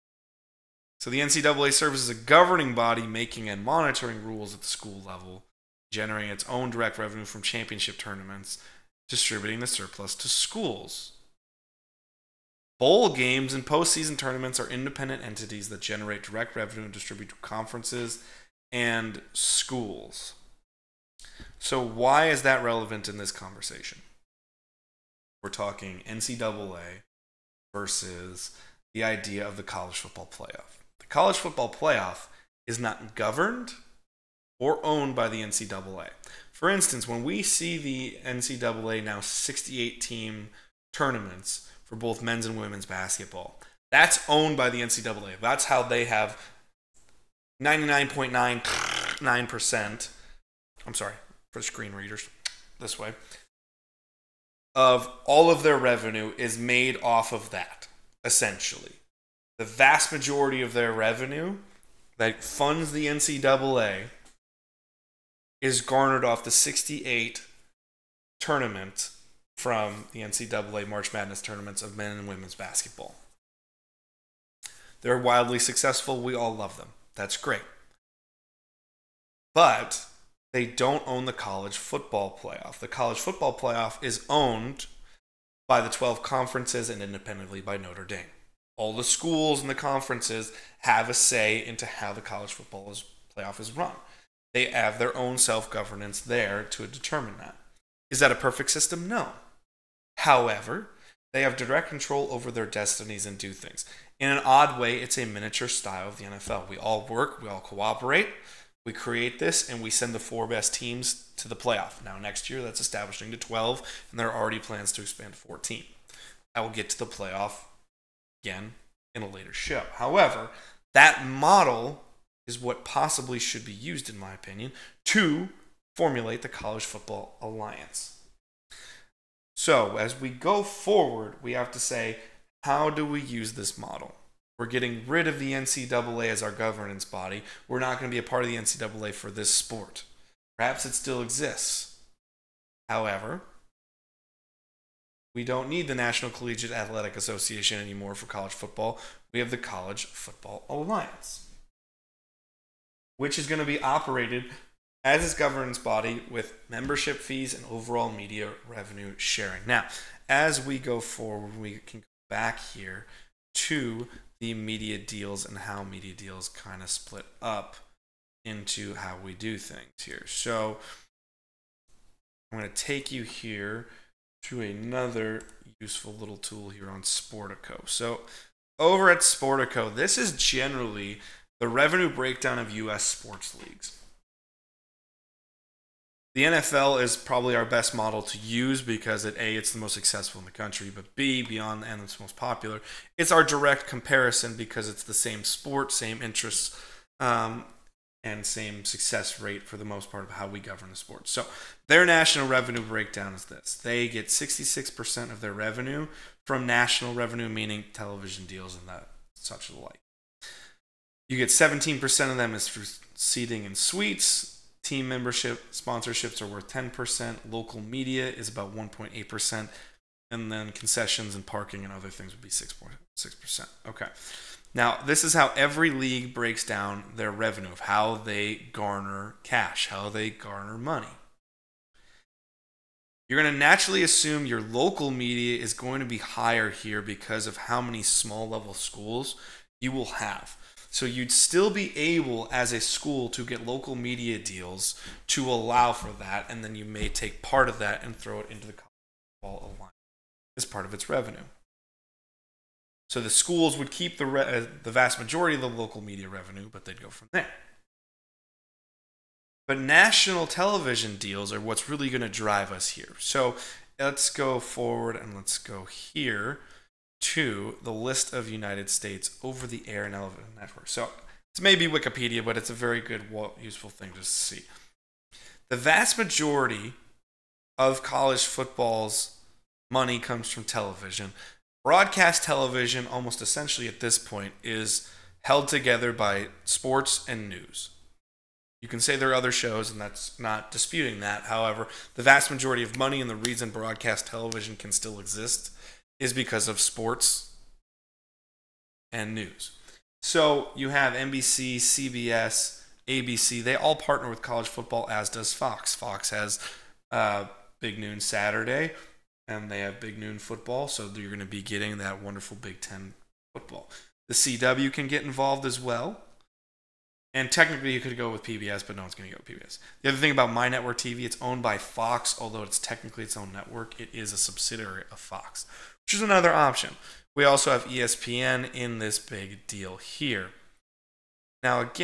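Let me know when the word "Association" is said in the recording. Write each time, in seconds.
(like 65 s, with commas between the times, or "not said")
147 s.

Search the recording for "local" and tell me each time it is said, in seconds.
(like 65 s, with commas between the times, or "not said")
217 s, 234 s, 243 s, 255 s.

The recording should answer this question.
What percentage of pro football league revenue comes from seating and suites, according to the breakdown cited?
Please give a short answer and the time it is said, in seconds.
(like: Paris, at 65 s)
17%, at 211 s.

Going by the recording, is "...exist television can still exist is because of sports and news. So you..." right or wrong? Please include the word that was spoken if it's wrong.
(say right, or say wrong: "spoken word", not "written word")
wrong: "broadcast", not "exist".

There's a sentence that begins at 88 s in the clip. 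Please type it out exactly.
All the schools and the conferences have a say into how the college football playoff is run.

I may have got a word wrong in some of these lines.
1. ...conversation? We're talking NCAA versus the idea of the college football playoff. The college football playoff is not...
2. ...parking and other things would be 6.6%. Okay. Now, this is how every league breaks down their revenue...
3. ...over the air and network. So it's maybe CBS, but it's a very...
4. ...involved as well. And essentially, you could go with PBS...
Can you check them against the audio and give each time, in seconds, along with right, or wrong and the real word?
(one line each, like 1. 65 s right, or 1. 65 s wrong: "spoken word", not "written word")
1. 23 s right
2. 221 s right
3. 269 s wrong: "Wikipedia", not "CBS"
4. 315 s wrong: "technically", not "essentially".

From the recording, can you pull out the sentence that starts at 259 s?
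But national television deals are what's really going to drive us here.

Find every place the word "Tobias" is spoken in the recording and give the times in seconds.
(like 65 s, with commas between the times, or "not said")
not said.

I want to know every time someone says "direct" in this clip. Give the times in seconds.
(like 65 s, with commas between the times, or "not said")
6 s, 16 s, 101 s, 193 s.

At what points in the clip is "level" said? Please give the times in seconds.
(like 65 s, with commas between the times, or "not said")
5 s, 238 s.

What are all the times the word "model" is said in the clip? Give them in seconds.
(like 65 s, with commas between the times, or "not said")
121 s, 133 s, 187 s.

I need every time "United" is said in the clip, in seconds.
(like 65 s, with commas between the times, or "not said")
268 s.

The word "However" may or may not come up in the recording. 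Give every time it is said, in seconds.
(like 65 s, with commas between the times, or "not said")
100 s, 119 s, 142 s, 291 s.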